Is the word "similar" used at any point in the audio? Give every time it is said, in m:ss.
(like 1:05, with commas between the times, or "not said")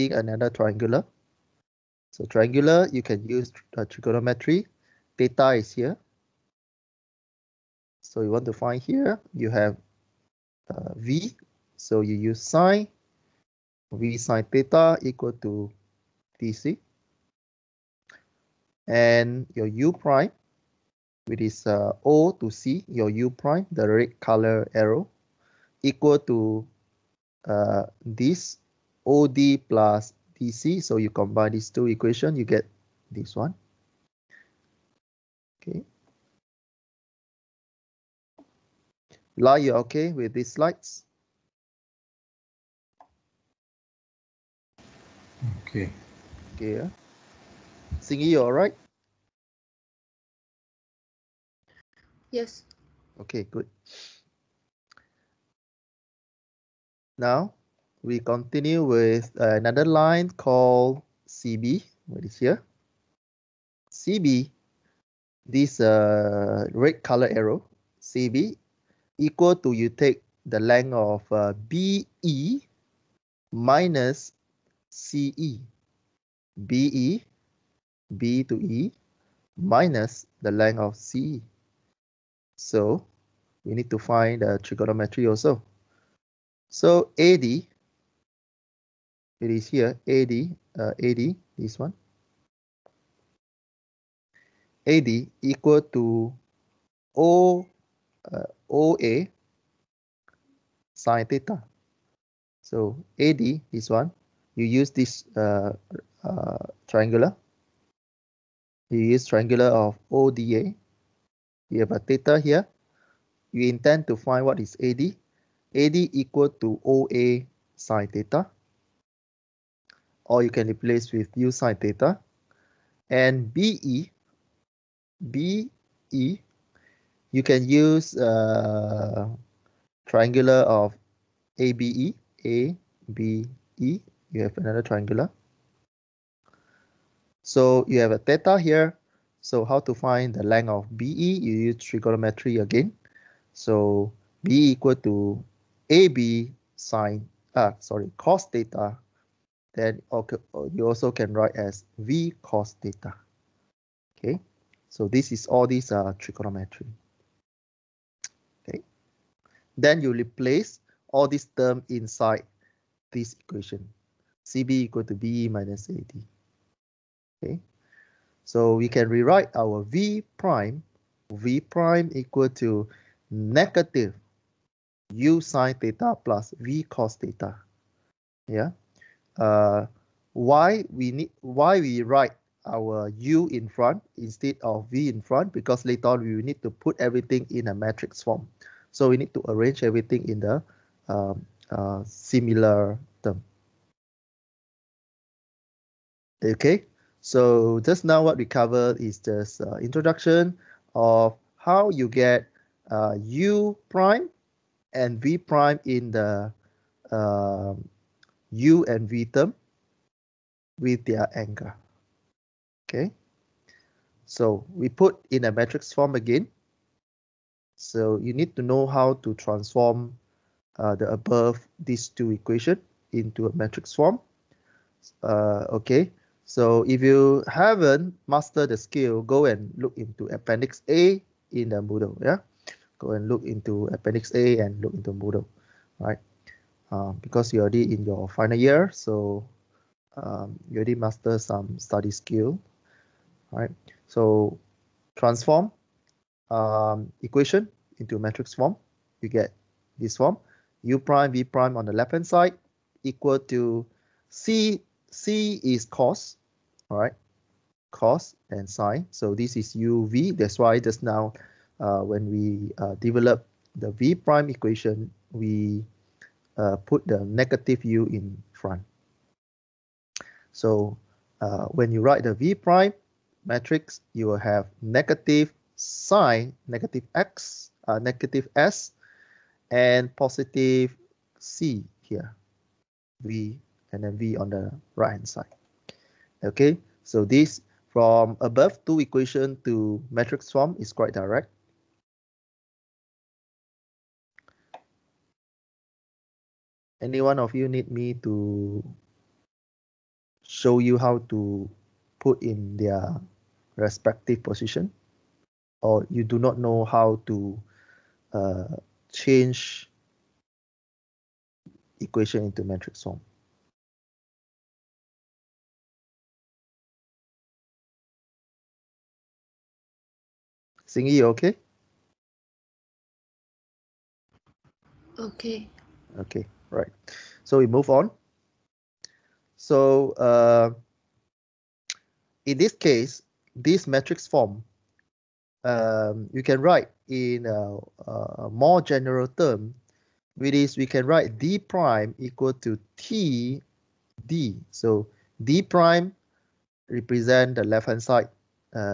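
3:12.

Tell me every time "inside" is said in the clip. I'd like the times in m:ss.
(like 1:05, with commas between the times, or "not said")
2:41.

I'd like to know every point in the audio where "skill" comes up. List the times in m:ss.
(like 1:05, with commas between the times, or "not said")
3:48, 4:02.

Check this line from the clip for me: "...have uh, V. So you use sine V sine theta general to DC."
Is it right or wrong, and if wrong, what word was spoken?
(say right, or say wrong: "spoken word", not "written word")
wrong: "equal", not "general".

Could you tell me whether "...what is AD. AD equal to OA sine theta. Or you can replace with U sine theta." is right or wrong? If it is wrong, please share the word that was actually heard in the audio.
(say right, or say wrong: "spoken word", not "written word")
right.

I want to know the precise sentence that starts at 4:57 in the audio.
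Any one of you need me to show you how to put in their respective position?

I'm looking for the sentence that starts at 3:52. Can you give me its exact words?
Yeah, go and look into Appendix A and look into Moodle, right?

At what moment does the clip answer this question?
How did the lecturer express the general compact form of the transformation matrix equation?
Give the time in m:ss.
5:41.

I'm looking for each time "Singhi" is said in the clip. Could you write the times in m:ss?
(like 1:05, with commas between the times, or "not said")
0:47, 5:20.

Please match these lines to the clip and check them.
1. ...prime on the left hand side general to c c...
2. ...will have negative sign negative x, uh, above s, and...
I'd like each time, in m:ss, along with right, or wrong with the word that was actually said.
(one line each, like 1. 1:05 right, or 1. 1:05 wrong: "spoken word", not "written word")
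1. 4:11 wrong: "equal", not "general"
2. 4:34 wrong: "negative", not "above".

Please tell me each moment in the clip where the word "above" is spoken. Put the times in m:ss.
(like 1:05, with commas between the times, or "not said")
3:41, 4:48.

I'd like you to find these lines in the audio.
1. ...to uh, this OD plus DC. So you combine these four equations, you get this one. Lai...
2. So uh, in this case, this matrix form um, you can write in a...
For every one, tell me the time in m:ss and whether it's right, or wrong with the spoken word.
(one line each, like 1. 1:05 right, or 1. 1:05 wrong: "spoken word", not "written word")
1. 0:26 wrong: "two", not "four"
2. 5:29 right.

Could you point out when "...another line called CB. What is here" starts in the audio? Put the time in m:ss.
0:59.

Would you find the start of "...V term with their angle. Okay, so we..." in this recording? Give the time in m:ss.
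3:29.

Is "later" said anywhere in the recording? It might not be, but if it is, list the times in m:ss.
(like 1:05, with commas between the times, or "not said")
3:05.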